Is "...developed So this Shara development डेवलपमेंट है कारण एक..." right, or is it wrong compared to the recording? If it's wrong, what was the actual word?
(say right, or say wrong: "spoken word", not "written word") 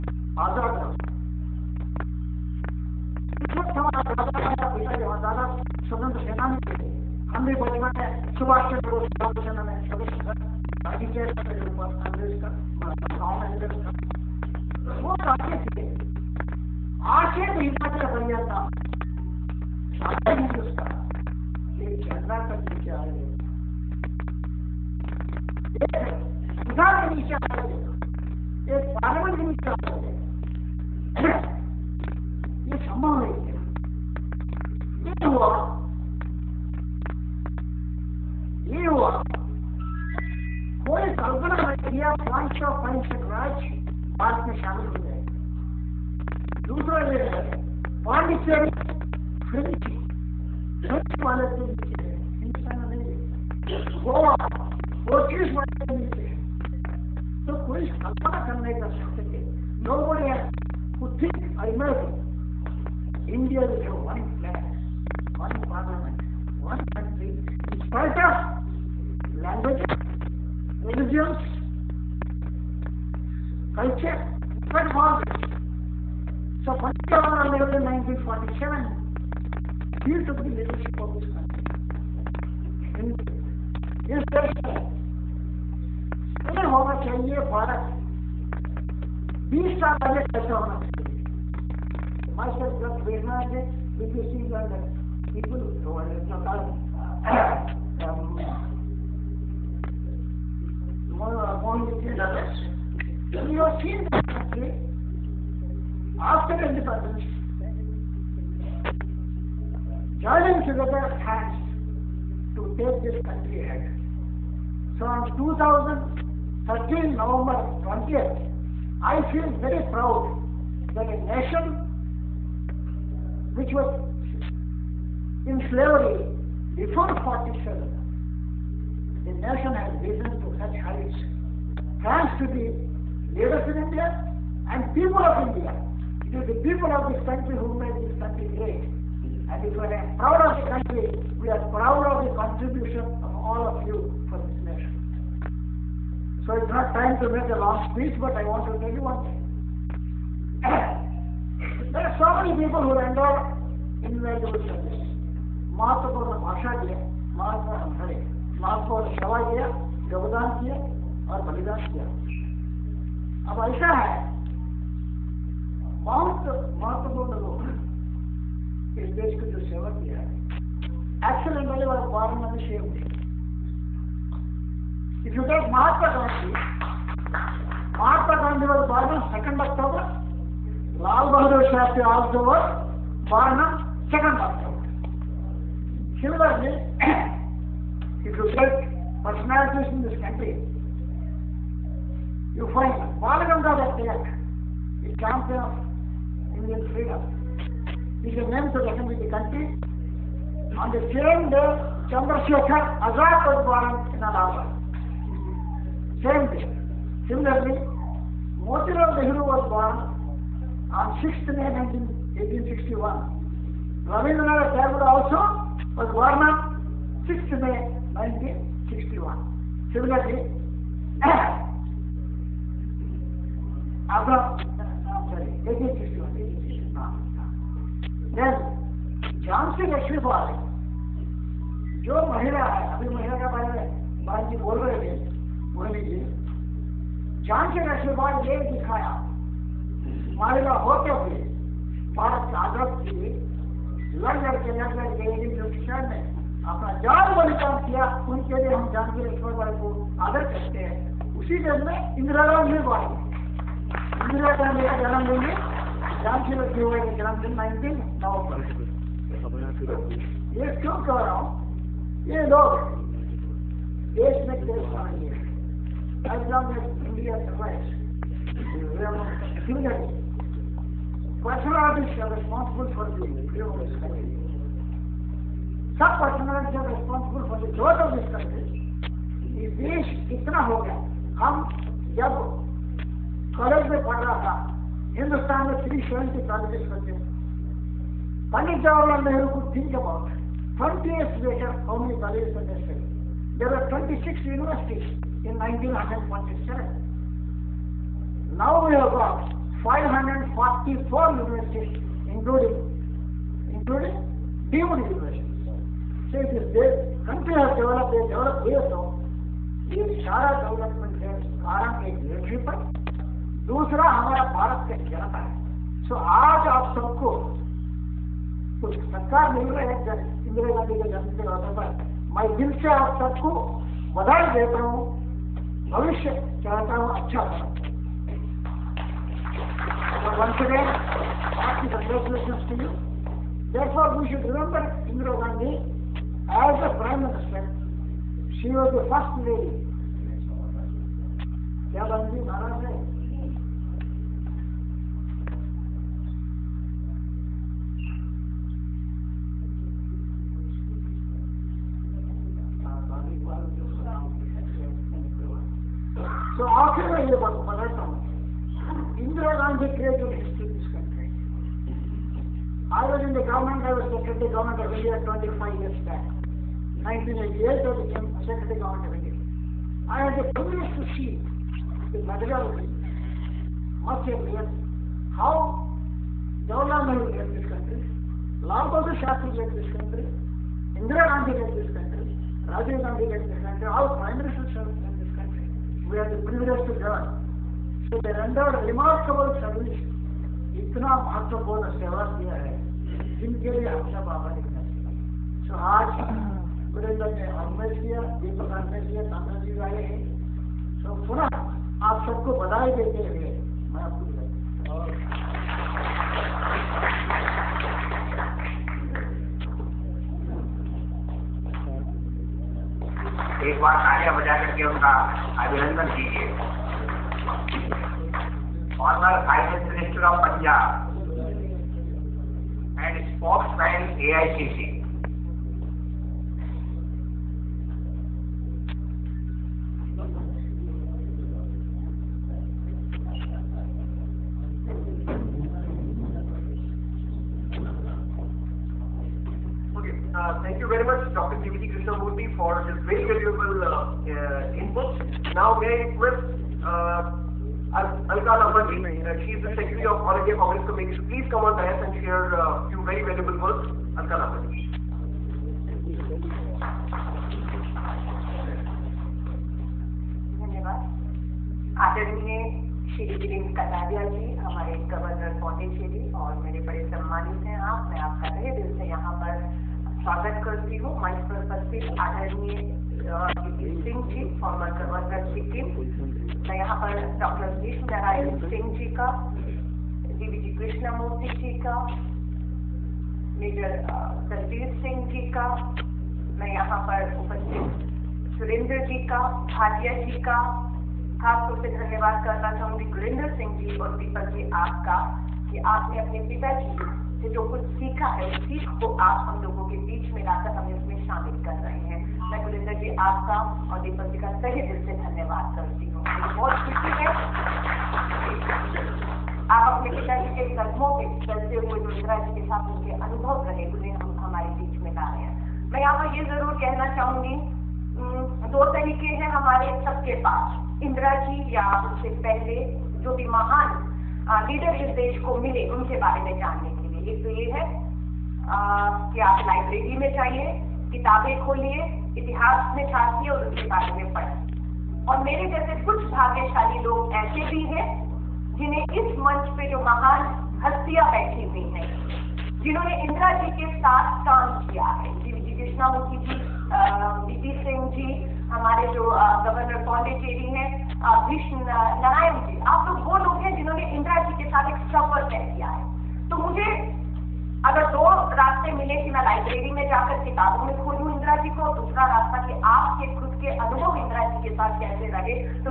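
right.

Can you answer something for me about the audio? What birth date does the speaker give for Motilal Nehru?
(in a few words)
6th May 1861.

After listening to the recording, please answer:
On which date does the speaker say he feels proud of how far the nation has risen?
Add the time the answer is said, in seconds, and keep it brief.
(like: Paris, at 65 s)
2013 November 20th, at 115 s.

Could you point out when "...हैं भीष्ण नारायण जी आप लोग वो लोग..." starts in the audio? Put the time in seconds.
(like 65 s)
550 s.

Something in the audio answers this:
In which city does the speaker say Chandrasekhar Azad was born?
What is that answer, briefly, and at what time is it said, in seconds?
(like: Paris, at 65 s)
Allahabad, at 204 s.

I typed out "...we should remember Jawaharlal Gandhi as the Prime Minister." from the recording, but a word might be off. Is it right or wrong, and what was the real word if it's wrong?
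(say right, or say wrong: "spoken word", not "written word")
wrong: "Indira", not "Jawaharlal".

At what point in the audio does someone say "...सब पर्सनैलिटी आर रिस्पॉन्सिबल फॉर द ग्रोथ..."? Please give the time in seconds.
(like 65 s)
275 s.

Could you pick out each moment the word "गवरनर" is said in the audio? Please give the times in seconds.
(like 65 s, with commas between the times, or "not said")
475 s, 549 s.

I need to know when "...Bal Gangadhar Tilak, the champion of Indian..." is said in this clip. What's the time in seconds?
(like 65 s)
193 s.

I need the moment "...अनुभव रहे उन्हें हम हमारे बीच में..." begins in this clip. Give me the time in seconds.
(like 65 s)
513 s.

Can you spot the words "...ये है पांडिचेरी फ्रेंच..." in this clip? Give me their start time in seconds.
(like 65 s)
47 s.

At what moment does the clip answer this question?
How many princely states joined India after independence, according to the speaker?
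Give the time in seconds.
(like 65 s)
42 s.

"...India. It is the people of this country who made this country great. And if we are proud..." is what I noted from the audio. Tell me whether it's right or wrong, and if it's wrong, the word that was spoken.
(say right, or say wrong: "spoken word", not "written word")
right.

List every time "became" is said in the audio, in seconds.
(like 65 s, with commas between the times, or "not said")
367 s.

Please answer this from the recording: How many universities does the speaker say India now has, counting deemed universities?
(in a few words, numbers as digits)
544.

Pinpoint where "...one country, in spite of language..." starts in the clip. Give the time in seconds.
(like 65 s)
66 s.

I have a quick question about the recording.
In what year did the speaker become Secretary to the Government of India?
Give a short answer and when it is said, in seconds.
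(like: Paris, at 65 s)
1988, at 367 s.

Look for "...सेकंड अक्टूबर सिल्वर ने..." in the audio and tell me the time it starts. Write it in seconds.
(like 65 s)
184 s.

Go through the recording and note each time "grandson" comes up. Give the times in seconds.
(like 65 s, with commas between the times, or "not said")
not said.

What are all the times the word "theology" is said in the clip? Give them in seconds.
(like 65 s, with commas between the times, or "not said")
not said.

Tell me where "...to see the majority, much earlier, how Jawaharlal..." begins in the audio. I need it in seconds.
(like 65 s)
371 s.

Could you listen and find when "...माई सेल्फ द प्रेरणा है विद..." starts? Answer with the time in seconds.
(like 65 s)
92 s.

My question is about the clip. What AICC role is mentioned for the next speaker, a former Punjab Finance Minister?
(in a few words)
spokesman.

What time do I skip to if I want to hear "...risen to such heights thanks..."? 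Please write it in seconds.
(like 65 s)
130 s.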